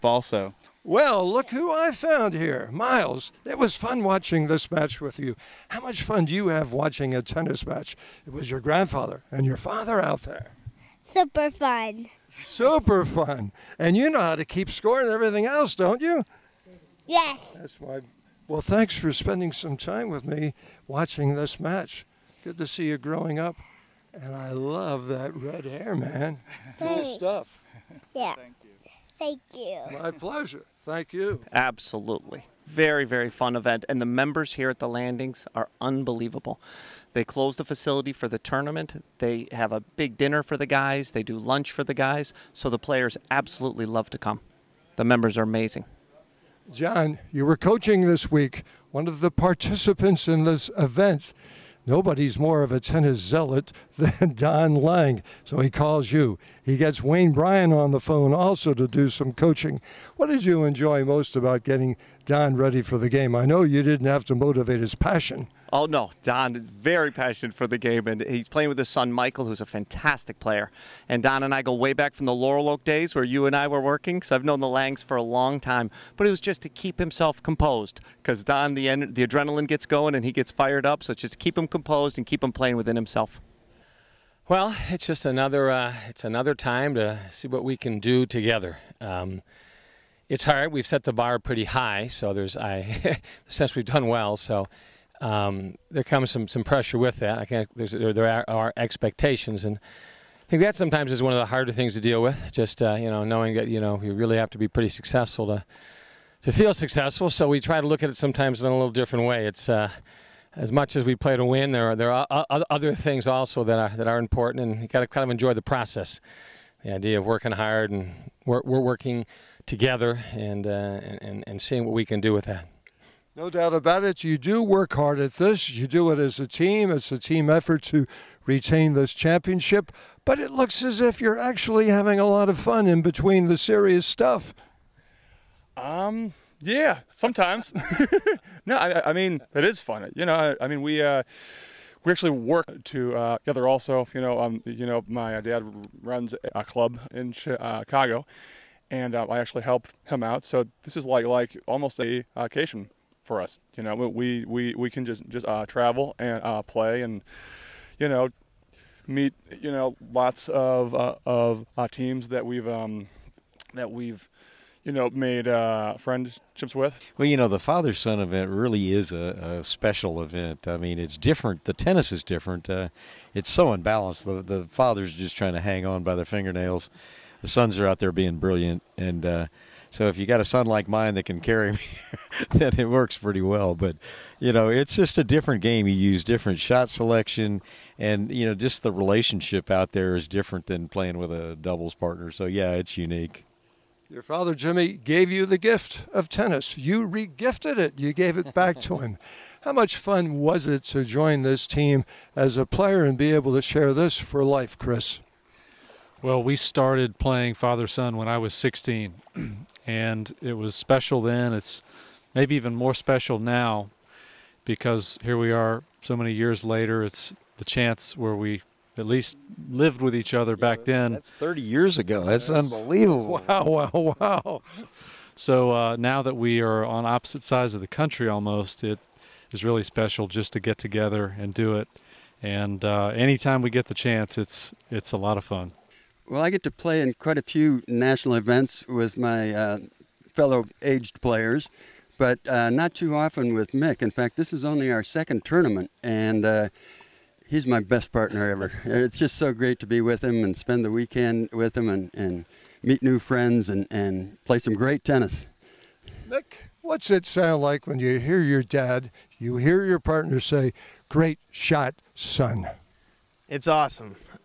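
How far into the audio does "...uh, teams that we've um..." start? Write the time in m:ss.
2:41.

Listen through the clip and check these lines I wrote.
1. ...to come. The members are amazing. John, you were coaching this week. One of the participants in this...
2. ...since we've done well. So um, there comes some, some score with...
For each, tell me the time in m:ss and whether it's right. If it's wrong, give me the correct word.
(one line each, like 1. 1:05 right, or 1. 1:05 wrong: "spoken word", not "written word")
1. 0:44 right
2. 1:33 wrong: "pressure", not "score".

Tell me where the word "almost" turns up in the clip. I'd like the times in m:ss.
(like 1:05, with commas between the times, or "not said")
2:31, 3:48.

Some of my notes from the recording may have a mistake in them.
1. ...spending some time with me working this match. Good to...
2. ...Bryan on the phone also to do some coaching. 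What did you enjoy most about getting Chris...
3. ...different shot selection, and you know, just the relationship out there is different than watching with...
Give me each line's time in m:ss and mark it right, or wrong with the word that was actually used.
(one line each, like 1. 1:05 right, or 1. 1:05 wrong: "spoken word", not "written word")
1. 0:19 wrong: "watching", not "working"
2. 0:57 wrong: "Don", not "Chris"
3. 3:06 wrong: "playing", not "watching".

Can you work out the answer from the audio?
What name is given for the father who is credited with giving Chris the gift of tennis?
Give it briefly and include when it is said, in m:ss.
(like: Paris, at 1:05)
Jimmy, at 3:14.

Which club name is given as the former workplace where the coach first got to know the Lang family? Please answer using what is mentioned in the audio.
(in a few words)
Laurel Oak.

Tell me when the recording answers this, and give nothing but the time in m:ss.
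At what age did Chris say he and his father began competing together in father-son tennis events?
3:28.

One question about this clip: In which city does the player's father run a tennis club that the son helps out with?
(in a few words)
Chicago.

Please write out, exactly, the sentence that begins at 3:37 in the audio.
It's the chance where we at least lived with each other back then.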